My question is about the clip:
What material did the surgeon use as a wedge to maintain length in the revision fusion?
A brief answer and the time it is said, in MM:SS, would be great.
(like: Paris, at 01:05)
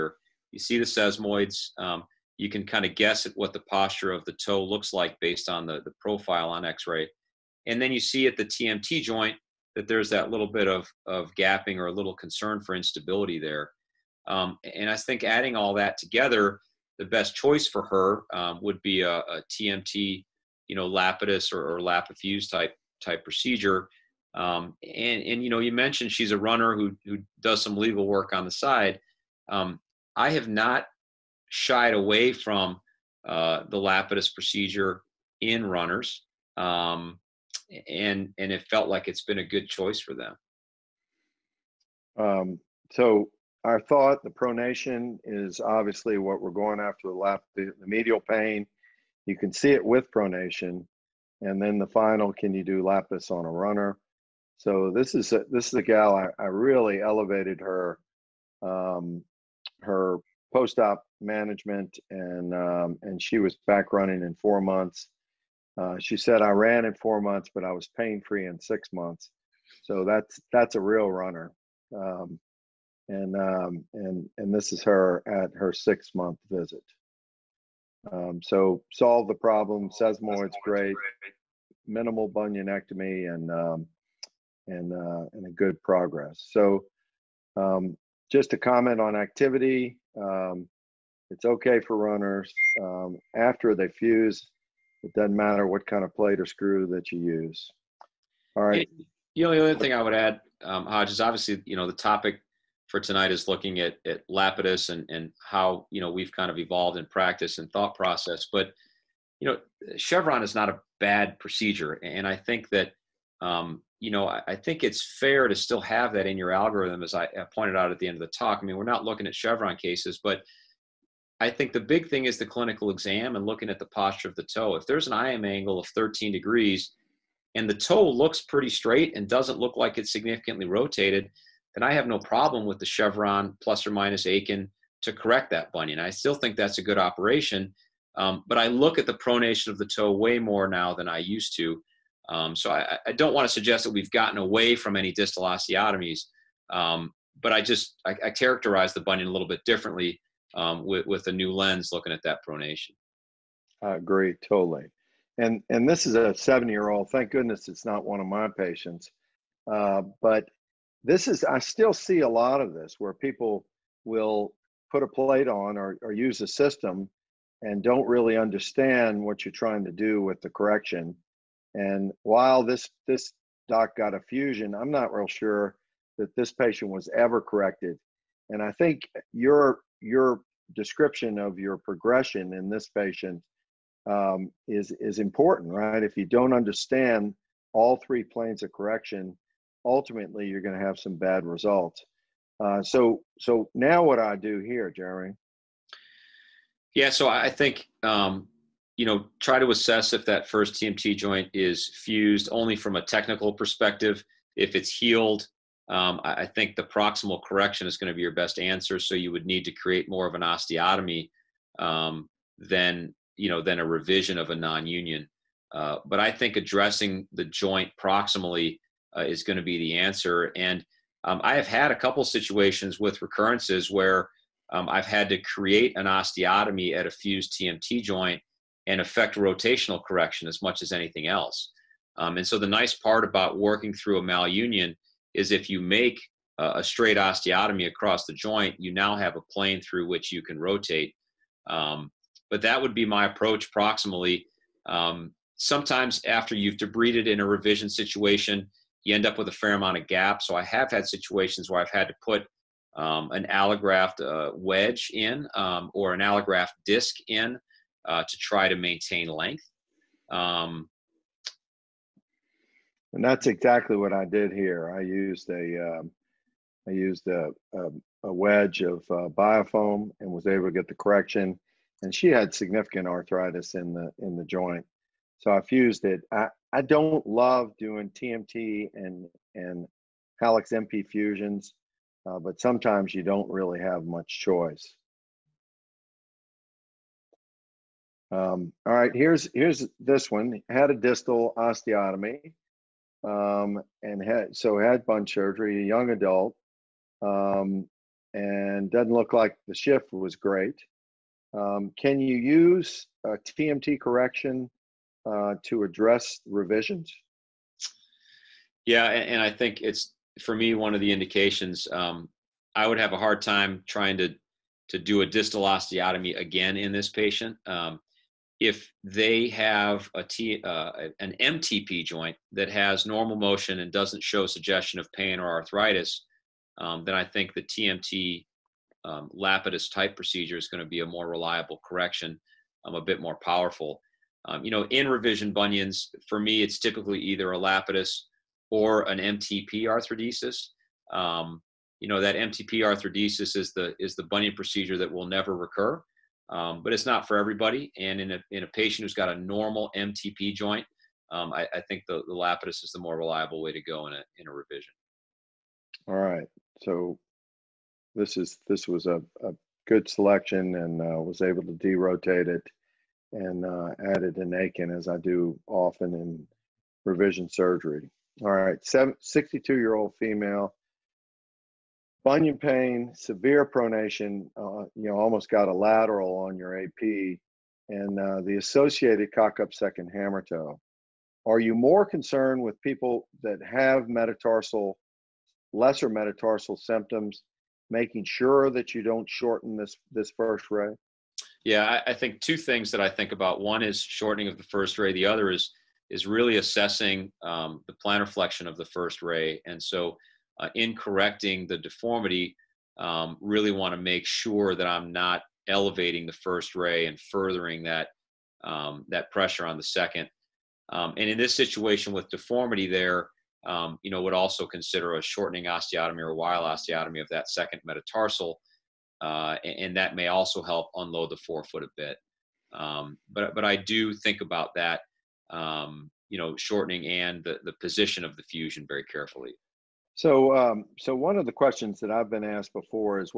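biofoam, at 04:29.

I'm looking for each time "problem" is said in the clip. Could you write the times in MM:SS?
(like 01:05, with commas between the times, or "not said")
01:19, 02:12.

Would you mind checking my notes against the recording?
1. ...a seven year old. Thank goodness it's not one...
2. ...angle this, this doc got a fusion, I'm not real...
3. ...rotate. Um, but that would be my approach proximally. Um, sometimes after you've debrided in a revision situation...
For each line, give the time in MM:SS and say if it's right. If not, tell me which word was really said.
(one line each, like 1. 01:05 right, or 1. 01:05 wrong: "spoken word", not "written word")
1. 02:36 right
2. 02:52 wrong: "while", not "angle"
3. 04:00 right.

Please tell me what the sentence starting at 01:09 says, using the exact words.
So that's that's a real runner.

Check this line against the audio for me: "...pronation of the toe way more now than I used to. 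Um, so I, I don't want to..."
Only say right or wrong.
right.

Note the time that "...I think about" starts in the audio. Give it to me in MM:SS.
06:32.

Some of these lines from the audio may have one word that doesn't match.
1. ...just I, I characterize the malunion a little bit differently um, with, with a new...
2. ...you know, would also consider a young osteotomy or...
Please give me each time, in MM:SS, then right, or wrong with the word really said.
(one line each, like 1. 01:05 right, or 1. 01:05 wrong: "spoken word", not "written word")
1. 02:27 wrong: "bunion", not "malunion"
2. 06:54 wrong: "shortening", not "young".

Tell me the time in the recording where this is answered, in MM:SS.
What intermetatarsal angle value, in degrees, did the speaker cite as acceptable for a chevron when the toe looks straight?
02:05.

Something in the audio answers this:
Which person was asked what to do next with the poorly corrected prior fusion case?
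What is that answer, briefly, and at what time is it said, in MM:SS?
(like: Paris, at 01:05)
Jeremy, at 03:14.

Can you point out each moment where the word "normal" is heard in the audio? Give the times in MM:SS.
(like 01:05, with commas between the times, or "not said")
05:23, 05:49.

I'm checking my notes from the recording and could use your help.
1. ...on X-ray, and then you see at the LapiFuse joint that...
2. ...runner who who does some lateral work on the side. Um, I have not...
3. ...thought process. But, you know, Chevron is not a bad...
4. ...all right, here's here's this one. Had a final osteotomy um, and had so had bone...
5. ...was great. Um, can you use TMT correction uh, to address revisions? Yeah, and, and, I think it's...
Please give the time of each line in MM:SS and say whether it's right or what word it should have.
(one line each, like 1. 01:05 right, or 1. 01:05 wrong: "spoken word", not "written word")
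1. 00:06 wrong: "TMT", not "LapiFuse"
2. 00:26 wrong: "legal", not "lateral"
3. 01:47 right
4. 04:48 wrong: "distal", not "final"
5. 05:00 right.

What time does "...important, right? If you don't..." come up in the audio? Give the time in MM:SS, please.
03:05.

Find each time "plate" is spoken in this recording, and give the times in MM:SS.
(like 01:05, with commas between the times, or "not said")
01:36, 02:45.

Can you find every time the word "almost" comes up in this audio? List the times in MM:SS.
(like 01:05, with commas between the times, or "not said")
06:15.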